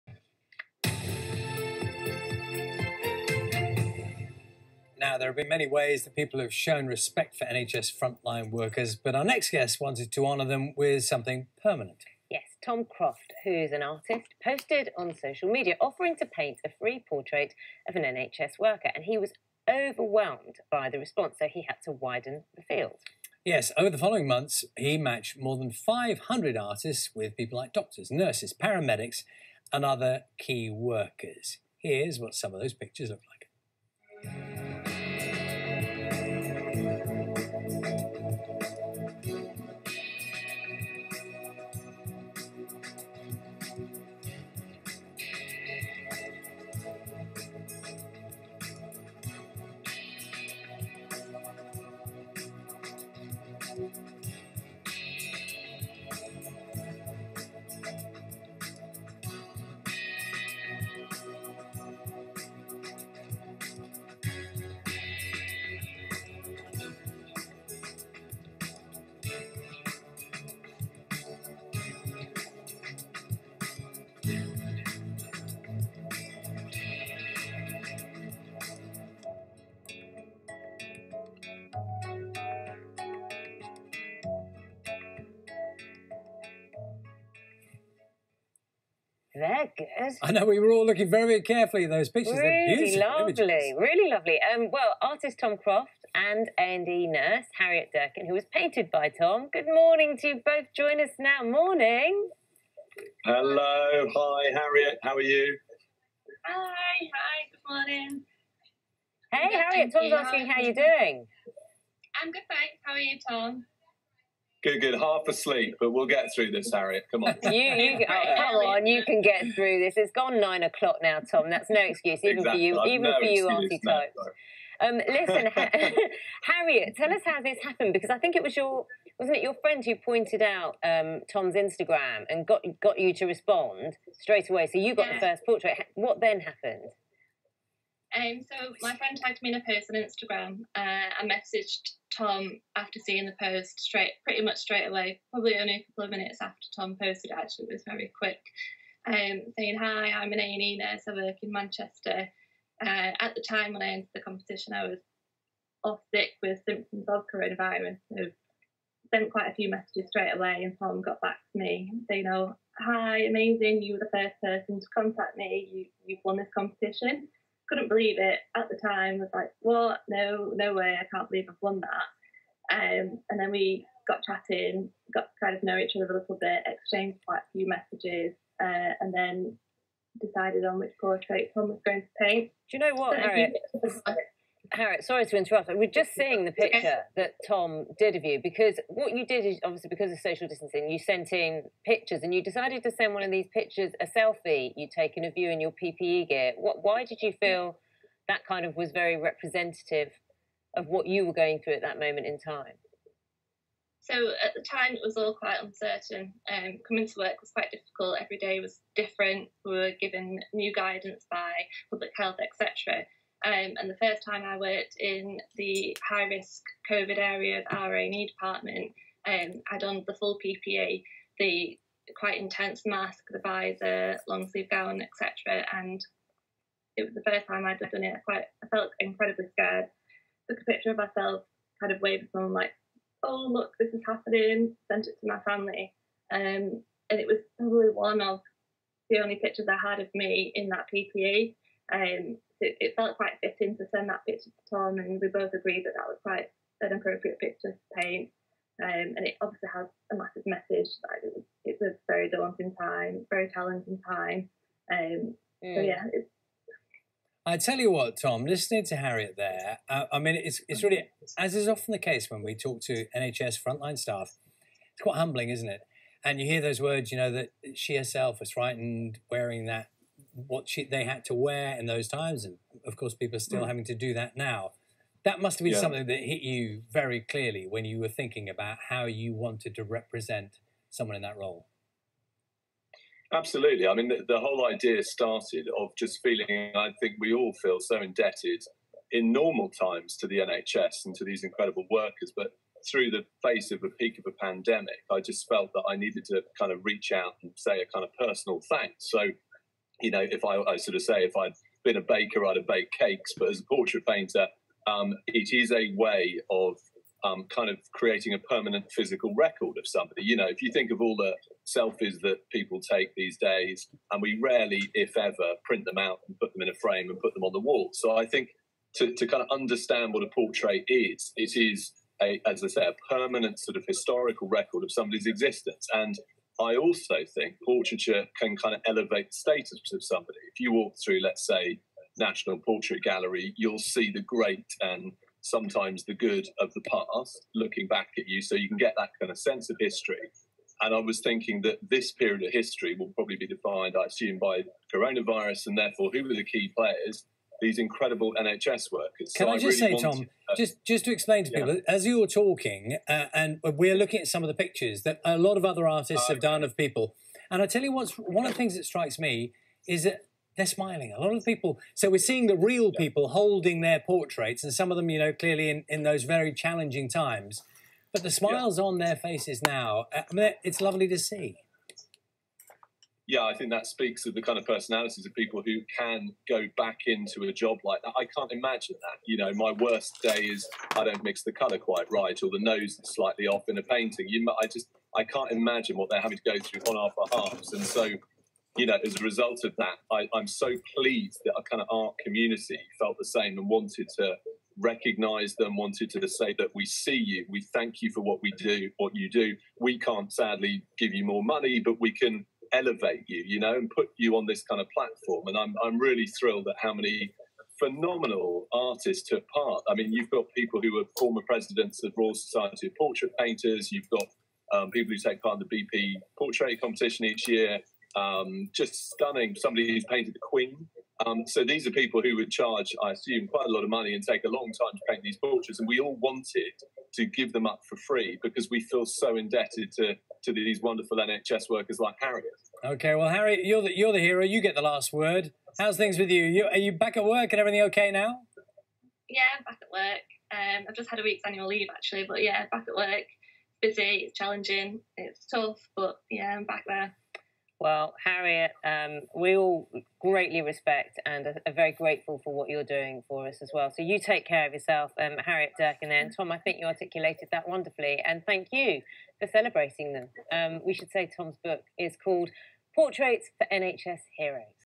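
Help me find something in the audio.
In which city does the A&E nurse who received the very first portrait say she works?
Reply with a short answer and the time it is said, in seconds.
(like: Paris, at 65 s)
Manchester, at 151 s.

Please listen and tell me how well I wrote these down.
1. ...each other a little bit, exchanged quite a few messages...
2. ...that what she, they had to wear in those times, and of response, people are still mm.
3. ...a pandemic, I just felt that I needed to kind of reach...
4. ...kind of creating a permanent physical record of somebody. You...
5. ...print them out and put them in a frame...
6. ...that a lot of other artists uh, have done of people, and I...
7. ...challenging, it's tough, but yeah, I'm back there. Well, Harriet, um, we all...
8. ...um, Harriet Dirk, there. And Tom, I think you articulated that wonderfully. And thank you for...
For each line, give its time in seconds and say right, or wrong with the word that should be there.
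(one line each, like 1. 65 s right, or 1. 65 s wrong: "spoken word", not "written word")
1. 175 s right
2. 269 s wrong: "course", not "response"
3. 294 s right
4. 307 s right
5. 315 s right
6. 355 s right
7. 444 s right
8. 455 s right.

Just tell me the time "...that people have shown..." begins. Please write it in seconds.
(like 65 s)
6 s.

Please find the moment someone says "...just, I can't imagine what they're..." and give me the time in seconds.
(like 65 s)
384 s.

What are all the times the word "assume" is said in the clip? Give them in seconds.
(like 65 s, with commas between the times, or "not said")
344 s, 423 s.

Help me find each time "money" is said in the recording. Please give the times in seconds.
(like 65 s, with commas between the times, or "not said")
401 s, 423 s.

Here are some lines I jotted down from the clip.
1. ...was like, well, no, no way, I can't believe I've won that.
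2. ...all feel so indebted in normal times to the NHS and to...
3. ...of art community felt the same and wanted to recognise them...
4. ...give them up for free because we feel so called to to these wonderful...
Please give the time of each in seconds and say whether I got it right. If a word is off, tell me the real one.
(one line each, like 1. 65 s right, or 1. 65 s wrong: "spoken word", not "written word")
1. 169 s right
2. 287 s right
3. 391 s right
4. 427 s wrong: "indebted", not "called".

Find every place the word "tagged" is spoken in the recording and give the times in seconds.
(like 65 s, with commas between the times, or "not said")
139 s.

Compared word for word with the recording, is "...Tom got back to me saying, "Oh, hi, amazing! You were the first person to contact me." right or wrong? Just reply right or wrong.
right.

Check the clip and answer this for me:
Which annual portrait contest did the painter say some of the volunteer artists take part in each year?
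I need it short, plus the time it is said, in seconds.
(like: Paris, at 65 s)
BP Portrait Competition, at 415 s.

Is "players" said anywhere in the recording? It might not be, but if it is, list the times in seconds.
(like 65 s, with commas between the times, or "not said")
346 s.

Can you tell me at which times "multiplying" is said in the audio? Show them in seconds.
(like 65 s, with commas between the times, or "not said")
not said.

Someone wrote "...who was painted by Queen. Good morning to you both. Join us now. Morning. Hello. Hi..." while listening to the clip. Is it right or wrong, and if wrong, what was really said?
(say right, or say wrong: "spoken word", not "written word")
wrong: "Tom", not "Queen".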